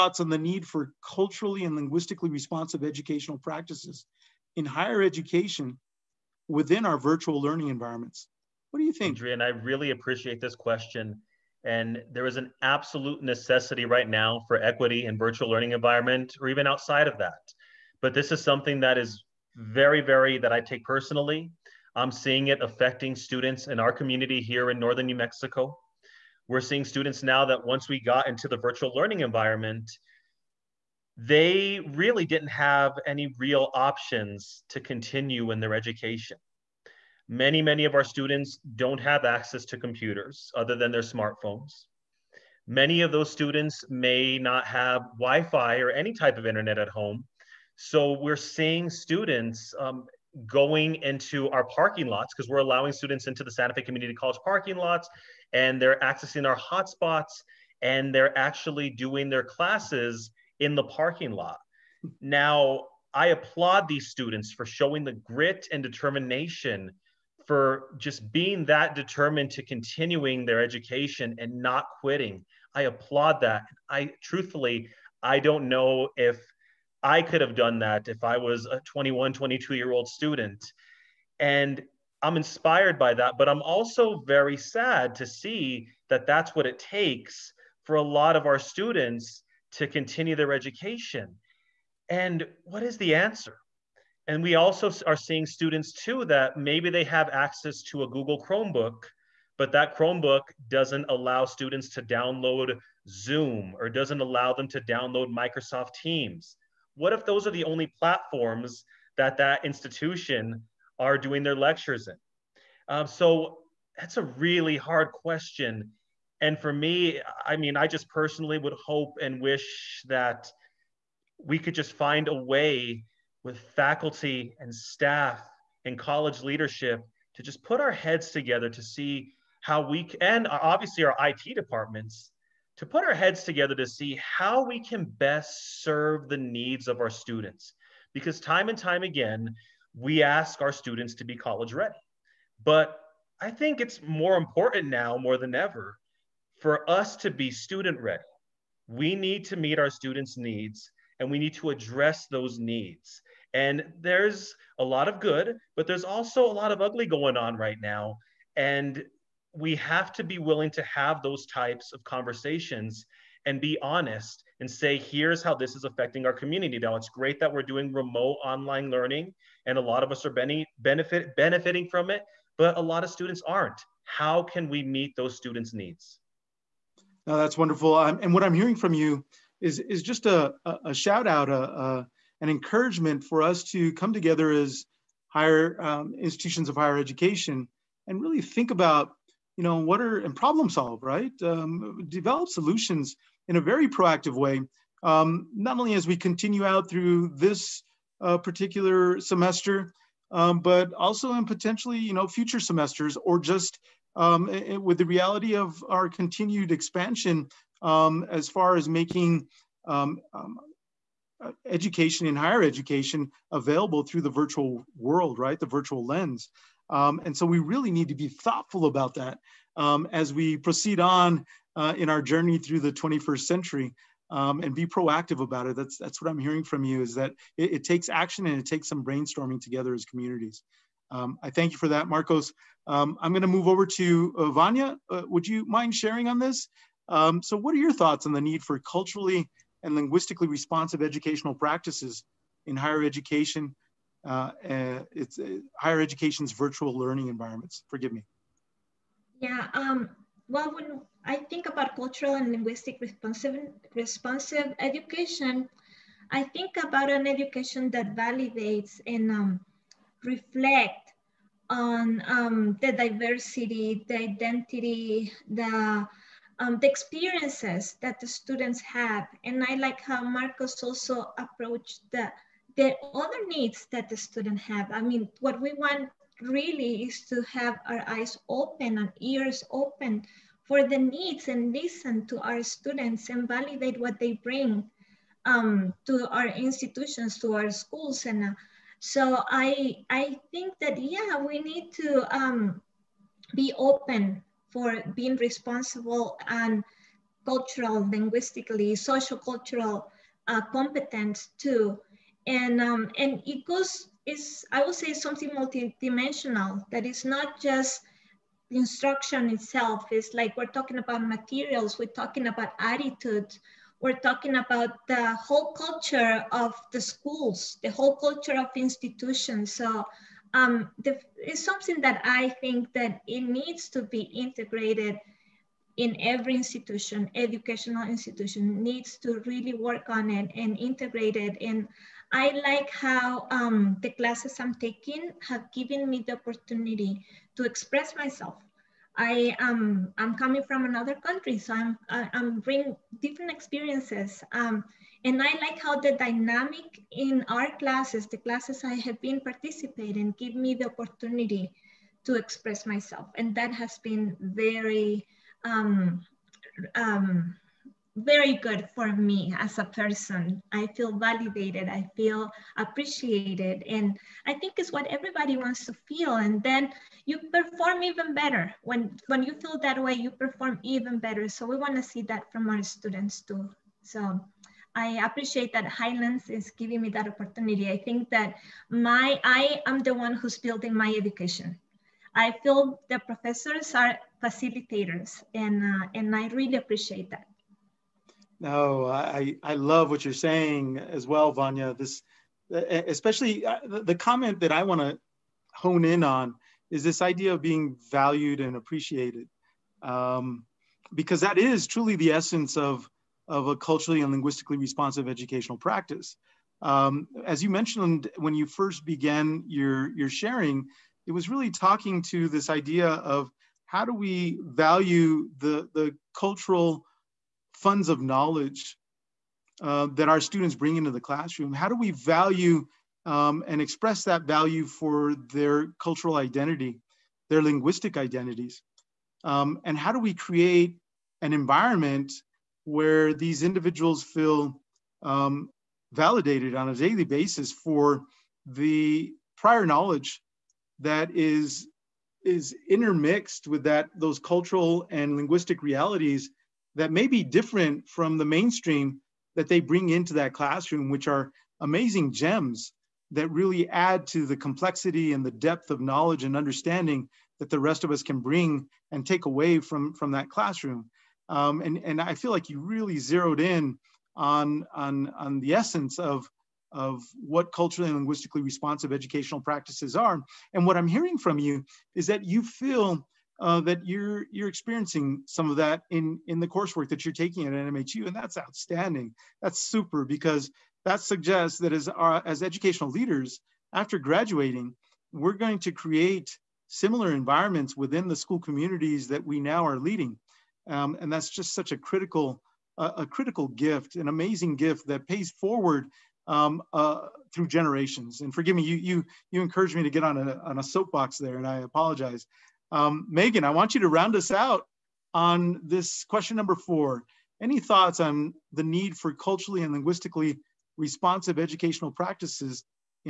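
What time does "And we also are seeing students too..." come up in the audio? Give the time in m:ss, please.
1:34.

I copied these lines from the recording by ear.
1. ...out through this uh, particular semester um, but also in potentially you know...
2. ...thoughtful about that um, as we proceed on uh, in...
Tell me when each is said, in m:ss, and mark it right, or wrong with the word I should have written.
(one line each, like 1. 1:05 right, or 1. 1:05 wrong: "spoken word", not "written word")
1. 3:16 right
2. 3:38 right.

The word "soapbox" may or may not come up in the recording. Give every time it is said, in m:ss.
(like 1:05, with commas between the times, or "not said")
8:20.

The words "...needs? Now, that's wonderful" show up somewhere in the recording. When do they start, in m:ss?
2:55.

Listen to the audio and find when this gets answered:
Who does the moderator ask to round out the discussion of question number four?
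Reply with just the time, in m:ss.
8:23.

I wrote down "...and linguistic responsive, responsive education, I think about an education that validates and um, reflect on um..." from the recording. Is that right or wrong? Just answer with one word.
right.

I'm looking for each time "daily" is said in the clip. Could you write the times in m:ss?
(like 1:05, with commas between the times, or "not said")
7:16.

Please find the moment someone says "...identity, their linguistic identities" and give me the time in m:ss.
7:06.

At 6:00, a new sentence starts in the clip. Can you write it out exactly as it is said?
I feel validated, I feel appreciated, and I think it's what everybody wants to feel.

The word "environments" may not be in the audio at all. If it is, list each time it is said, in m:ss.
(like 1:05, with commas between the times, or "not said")
0:07, 0:15, 0:29, 4:07, 7:11, 8:07.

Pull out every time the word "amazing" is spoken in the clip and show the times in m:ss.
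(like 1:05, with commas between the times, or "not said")
7:31, 8:14.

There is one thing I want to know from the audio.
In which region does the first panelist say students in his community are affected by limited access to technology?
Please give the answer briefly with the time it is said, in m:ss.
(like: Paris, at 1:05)
northern New Mexico, at 0:24.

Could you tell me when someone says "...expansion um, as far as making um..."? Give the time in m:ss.
3:26.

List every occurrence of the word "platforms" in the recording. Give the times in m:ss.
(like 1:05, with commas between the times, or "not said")
1:47.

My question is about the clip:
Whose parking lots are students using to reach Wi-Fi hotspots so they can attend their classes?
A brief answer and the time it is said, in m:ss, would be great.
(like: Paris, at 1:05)
Santa Fe Community College, at 0:53.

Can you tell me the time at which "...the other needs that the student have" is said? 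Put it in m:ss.
4:32.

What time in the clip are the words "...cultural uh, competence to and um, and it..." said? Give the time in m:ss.
4:59.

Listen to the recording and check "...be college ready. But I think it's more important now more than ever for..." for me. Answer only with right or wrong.
right.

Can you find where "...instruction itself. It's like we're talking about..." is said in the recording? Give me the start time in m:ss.
5:08.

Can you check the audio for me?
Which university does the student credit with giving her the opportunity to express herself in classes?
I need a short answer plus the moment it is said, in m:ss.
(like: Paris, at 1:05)
Highlands, at 6:15.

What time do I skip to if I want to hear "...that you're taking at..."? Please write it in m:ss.
7:57.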